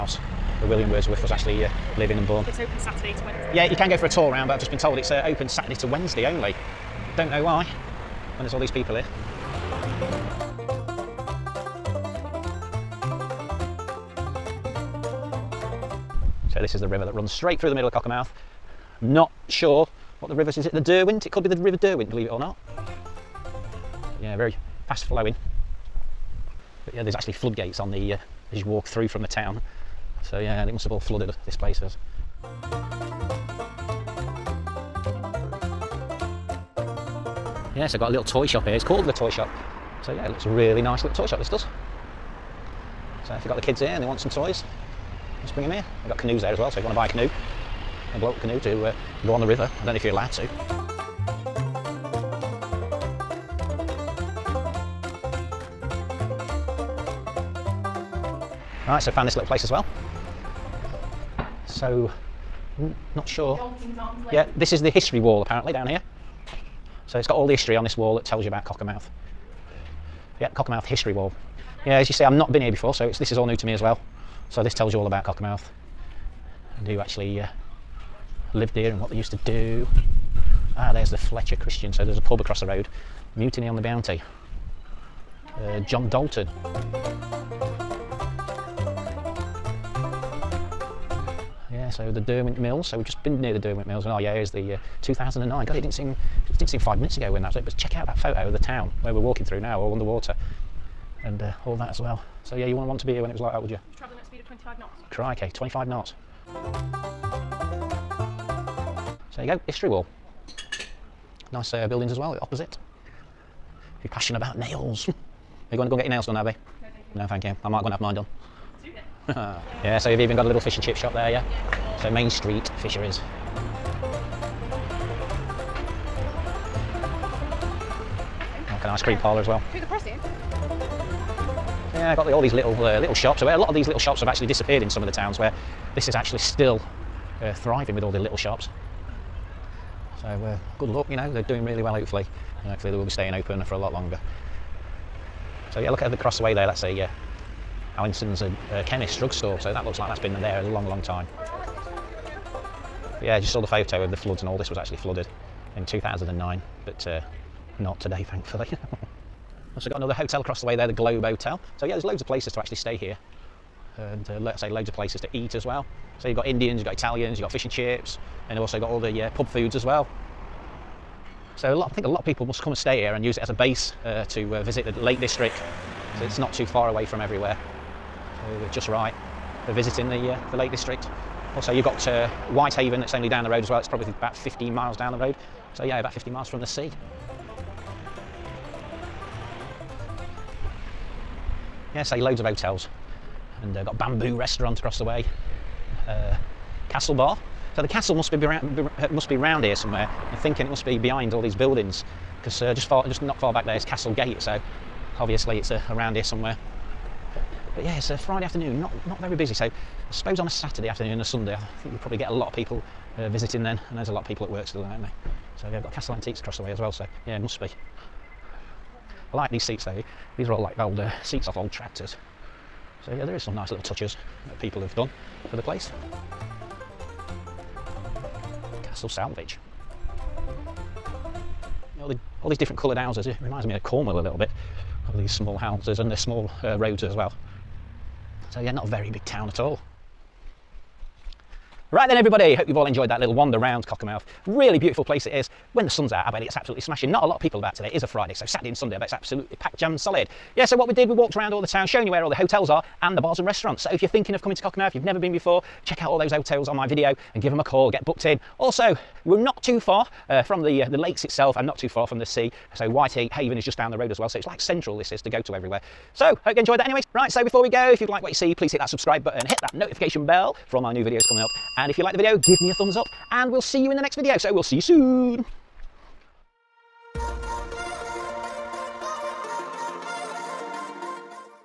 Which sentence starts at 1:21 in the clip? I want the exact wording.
So there's a pub across the road.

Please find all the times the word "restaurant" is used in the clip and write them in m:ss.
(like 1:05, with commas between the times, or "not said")
3:14, 4:13.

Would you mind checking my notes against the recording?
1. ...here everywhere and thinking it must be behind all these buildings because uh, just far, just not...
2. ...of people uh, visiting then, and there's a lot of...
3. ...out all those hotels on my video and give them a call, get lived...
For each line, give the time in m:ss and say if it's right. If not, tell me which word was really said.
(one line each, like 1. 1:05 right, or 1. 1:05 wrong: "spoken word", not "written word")
1. 3:19 wrong: "somewhere", not "everywhere"
2. 3:32 right
3. 4:16 wrong: "booked", not "lived".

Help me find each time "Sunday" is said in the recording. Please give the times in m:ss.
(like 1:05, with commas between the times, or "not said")
3:31, 4:08.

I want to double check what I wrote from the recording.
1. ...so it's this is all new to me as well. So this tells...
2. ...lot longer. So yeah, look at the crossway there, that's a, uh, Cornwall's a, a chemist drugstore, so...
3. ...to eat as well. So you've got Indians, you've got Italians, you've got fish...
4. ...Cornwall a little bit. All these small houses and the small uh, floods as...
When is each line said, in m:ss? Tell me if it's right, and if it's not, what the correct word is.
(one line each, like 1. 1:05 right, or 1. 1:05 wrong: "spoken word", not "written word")
1. 1:12 right
2. 2:23 wrong: "Allinson", not "Cornwall"
3. 2:45 right
4. 3:53 wrong: "roads", not "floods".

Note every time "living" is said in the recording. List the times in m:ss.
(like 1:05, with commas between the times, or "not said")
0:01.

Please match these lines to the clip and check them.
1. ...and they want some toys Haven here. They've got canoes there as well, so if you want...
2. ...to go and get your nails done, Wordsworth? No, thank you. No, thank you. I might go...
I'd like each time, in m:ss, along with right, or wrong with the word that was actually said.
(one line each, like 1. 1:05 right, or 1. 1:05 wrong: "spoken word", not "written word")
1. 0:43 wrong: "Bring", not "Haven"
2. 1:55 wrong: "Abby", not "Wordsworth".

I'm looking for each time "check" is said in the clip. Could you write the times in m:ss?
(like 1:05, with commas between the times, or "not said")
1:37, 4:15.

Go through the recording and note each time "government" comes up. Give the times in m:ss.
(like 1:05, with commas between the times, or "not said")
not said.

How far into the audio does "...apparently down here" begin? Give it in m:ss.
1:05.